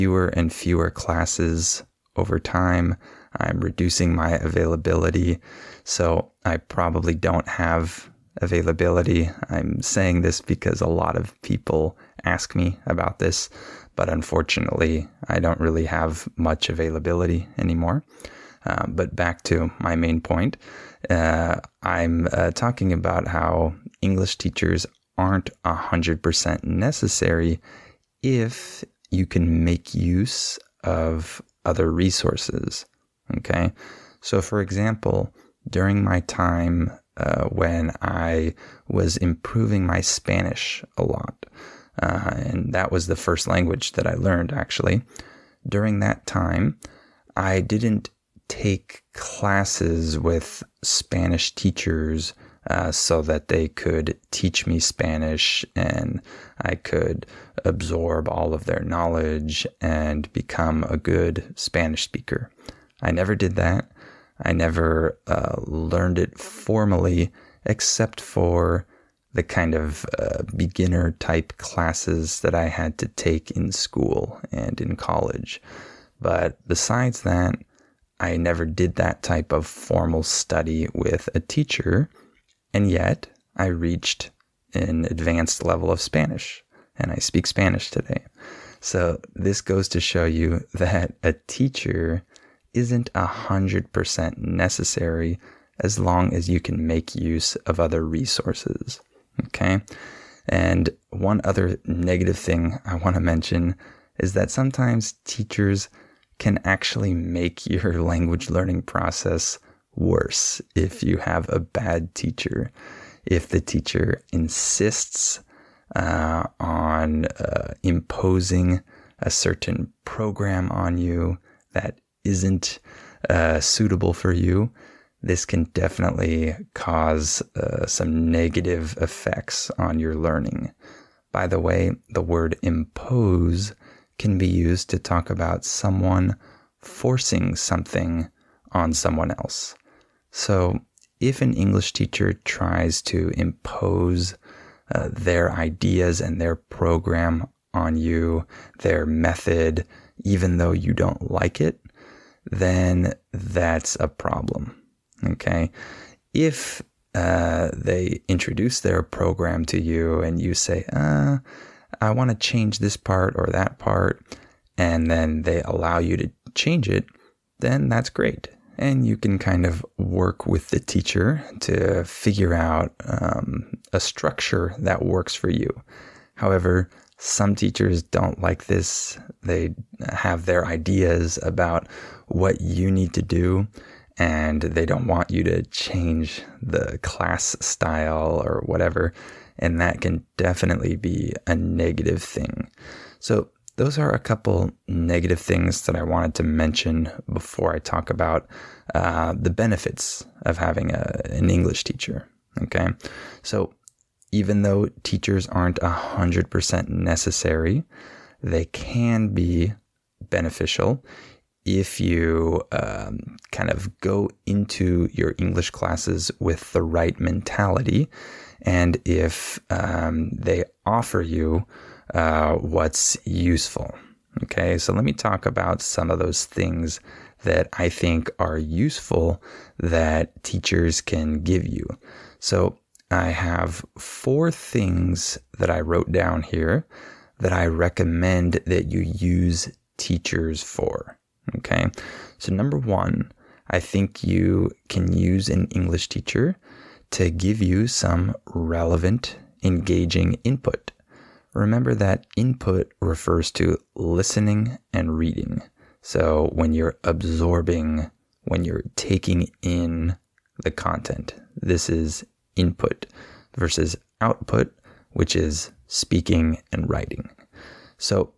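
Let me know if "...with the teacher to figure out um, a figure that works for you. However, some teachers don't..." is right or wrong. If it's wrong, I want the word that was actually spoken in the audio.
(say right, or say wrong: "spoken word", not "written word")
wrong: "structure", not "figure".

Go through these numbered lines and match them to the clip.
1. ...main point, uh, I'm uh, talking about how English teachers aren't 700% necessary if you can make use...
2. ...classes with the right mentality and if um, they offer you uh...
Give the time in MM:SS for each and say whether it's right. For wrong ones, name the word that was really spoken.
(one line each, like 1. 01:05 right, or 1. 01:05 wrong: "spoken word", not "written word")
1. 00:19 wrong: "100", not "700"
2. 03:35 right.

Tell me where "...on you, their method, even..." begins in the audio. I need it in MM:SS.
02:27.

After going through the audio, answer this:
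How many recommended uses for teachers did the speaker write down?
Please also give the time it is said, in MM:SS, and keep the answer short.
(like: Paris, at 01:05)
4, at 03:53.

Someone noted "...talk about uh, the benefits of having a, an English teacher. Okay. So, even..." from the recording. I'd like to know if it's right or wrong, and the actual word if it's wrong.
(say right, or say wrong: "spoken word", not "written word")
right.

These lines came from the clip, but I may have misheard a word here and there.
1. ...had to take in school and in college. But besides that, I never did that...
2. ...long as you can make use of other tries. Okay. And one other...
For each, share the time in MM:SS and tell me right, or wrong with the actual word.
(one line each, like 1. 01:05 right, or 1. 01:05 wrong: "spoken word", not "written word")
1. 01:12 right
2. 01:35 wrong: "resources", not "tries".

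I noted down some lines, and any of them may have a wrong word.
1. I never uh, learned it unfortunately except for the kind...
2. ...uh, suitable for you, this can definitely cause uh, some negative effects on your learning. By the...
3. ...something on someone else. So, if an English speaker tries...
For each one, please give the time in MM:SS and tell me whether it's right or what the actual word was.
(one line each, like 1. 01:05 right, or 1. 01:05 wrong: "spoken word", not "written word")
1. 01:04 wrong: "formally", not "unfortunately"
2. 02:03 right
3. 02:17 wrong: "teacher", not "speaker".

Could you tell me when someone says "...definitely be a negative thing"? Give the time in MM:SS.
03:10.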